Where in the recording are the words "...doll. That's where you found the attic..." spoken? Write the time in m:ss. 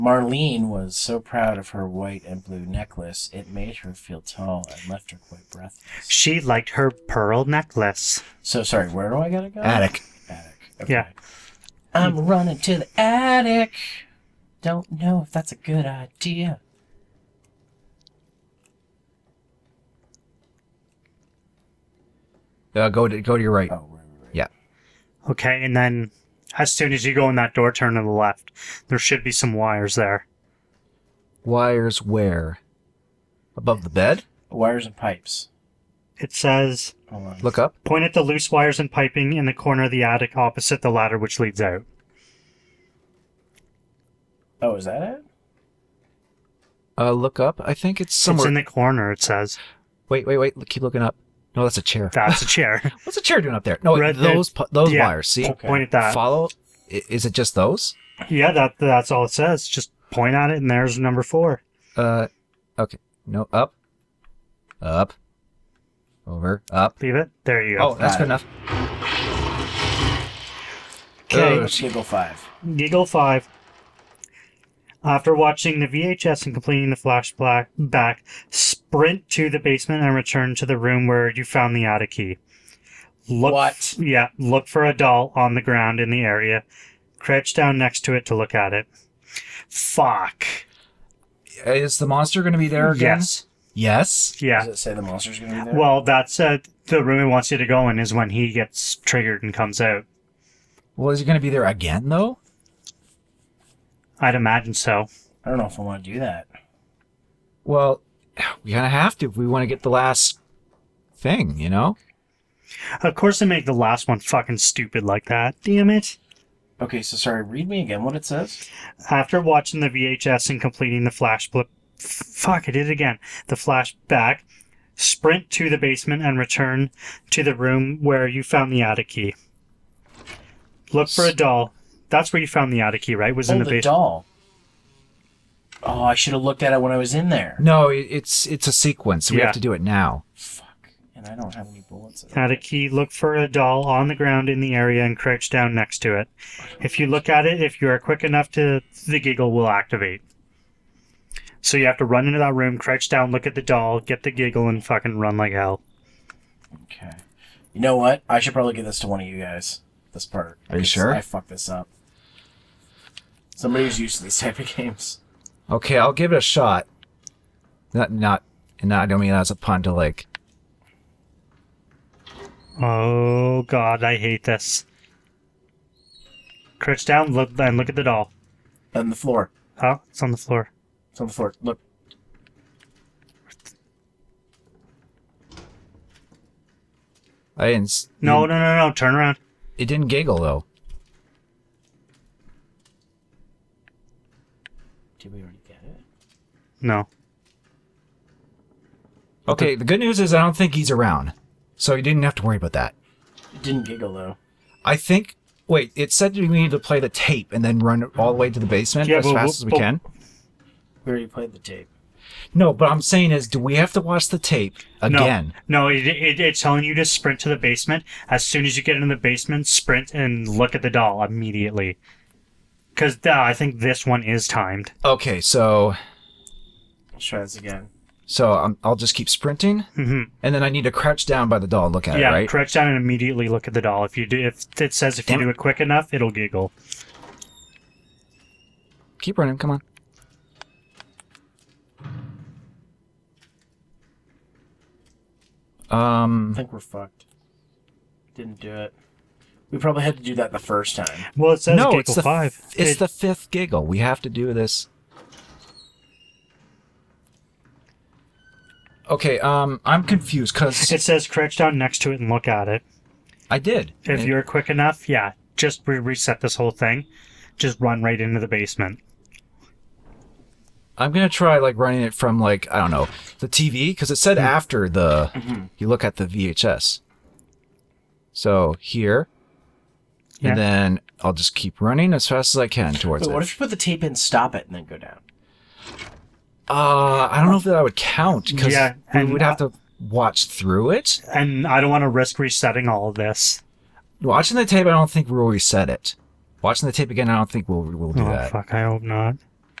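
2:11.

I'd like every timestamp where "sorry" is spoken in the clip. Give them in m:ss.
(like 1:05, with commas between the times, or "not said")
0:08, 1:57.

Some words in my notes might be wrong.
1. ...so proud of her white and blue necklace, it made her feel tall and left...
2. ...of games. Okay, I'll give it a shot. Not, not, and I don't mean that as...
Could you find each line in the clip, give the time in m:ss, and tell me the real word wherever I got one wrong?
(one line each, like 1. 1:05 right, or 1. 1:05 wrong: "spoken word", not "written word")
1. 0:00 right
2. 2:44 right.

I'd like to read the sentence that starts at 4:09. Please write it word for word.
We probably had to do that the first time.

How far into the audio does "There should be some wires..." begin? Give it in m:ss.
0:28.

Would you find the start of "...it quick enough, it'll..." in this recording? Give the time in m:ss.
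3:55.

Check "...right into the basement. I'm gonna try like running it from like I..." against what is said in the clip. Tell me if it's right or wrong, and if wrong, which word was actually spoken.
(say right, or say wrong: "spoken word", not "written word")
right.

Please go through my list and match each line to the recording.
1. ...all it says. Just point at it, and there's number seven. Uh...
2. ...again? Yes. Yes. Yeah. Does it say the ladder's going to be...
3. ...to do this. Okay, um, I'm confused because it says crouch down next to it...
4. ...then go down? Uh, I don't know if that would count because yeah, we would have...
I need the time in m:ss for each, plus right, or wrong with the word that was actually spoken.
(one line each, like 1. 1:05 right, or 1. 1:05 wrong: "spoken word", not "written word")
1. 0:59 wrong: "four", not "seven"
2. 1:32 wrong: "monster", not "ladder"
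3. 4:14 right
4. 4:44 right.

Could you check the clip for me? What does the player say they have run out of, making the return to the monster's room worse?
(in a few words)
Bullets.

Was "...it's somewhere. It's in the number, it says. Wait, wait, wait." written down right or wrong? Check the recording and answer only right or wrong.
wrong.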